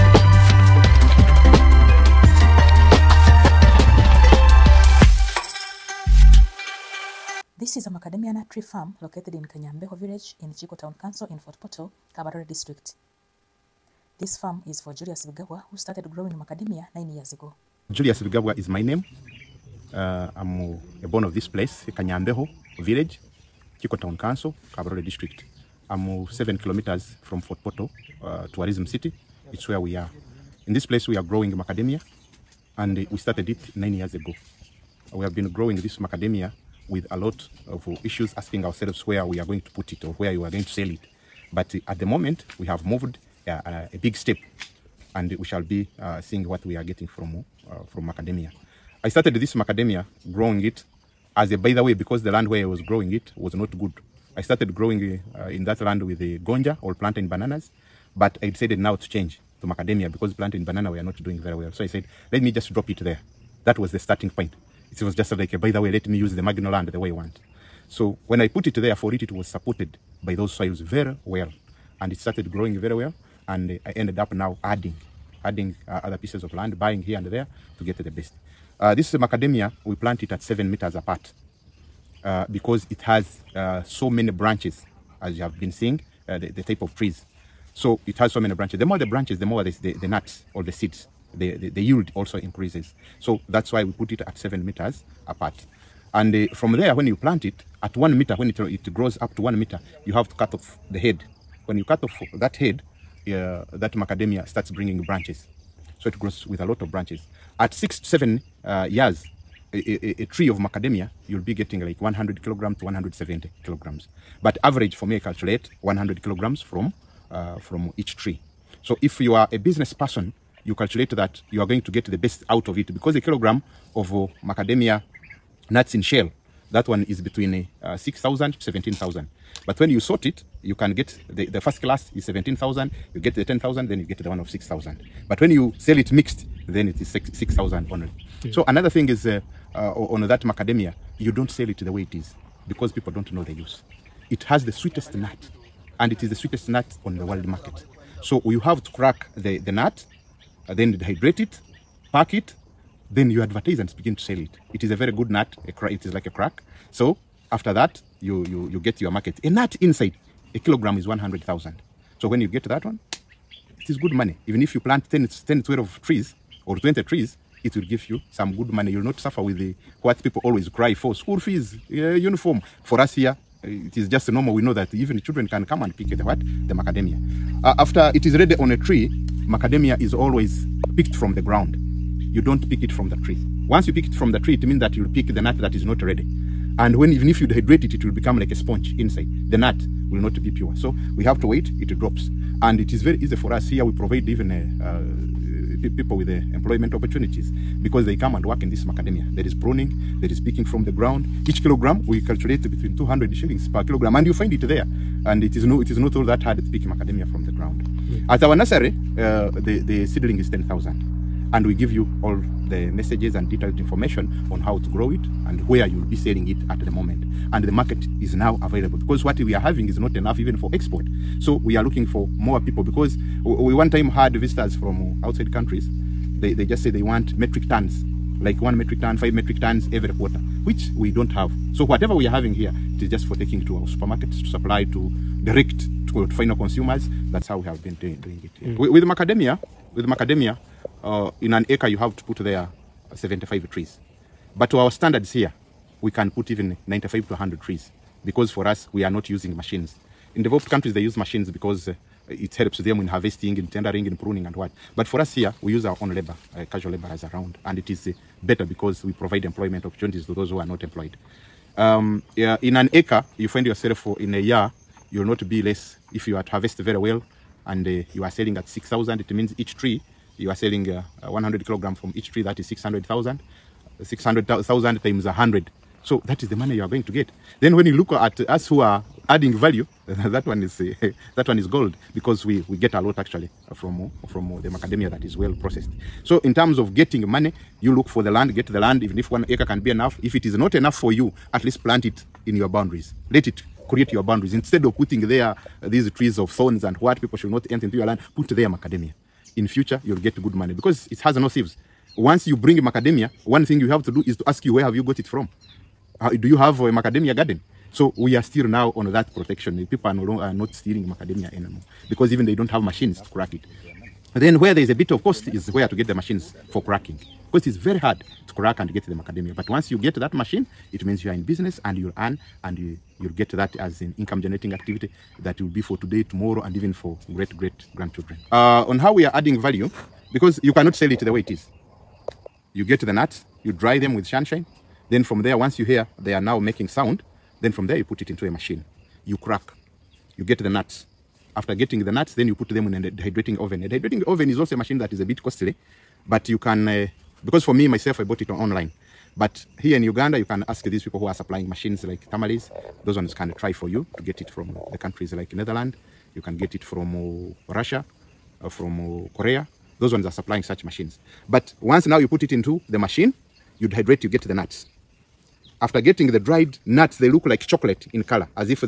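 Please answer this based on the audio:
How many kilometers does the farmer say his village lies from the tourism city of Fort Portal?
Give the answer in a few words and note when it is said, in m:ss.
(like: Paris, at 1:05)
7, at 0:26.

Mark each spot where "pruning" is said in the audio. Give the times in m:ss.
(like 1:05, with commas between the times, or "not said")
3:19, 4:14.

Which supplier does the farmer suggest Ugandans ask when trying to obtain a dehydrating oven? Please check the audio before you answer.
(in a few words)
Tamales.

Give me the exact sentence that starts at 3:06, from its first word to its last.
And when even if you dehydrate it, it will become like a sponge inside.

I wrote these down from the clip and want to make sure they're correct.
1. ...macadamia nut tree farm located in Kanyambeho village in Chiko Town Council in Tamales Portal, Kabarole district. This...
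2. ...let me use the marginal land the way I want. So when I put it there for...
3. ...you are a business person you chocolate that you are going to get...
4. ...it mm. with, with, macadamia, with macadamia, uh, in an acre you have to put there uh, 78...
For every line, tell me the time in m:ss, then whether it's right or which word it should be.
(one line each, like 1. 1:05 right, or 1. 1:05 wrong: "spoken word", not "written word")
1. 0:07 wrong: "Fort", not "Tamales"
2. 1:05 right
3. 1:59 wrong: "calculate", not "chocolate"
4. 3:58 wrong: "75", not "78".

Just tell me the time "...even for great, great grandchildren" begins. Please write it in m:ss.
5:26.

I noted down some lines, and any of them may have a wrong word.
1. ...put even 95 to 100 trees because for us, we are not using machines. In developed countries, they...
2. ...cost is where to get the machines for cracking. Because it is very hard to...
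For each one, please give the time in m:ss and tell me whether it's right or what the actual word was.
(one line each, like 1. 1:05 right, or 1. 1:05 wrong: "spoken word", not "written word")
1. 4:06 right
2. 5:15 right.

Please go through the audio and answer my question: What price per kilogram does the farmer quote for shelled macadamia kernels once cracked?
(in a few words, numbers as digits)
100,000.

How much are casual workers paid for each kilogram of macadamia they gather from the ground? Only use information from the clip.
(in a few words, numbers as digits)
200 shillings.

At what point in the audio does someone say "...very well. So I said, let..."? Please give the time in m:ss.
1:01.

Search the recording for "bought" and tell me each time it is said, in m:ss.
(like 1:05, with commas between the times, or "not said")
5:48.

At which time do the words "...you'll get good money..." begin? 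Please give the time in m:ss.
5:00.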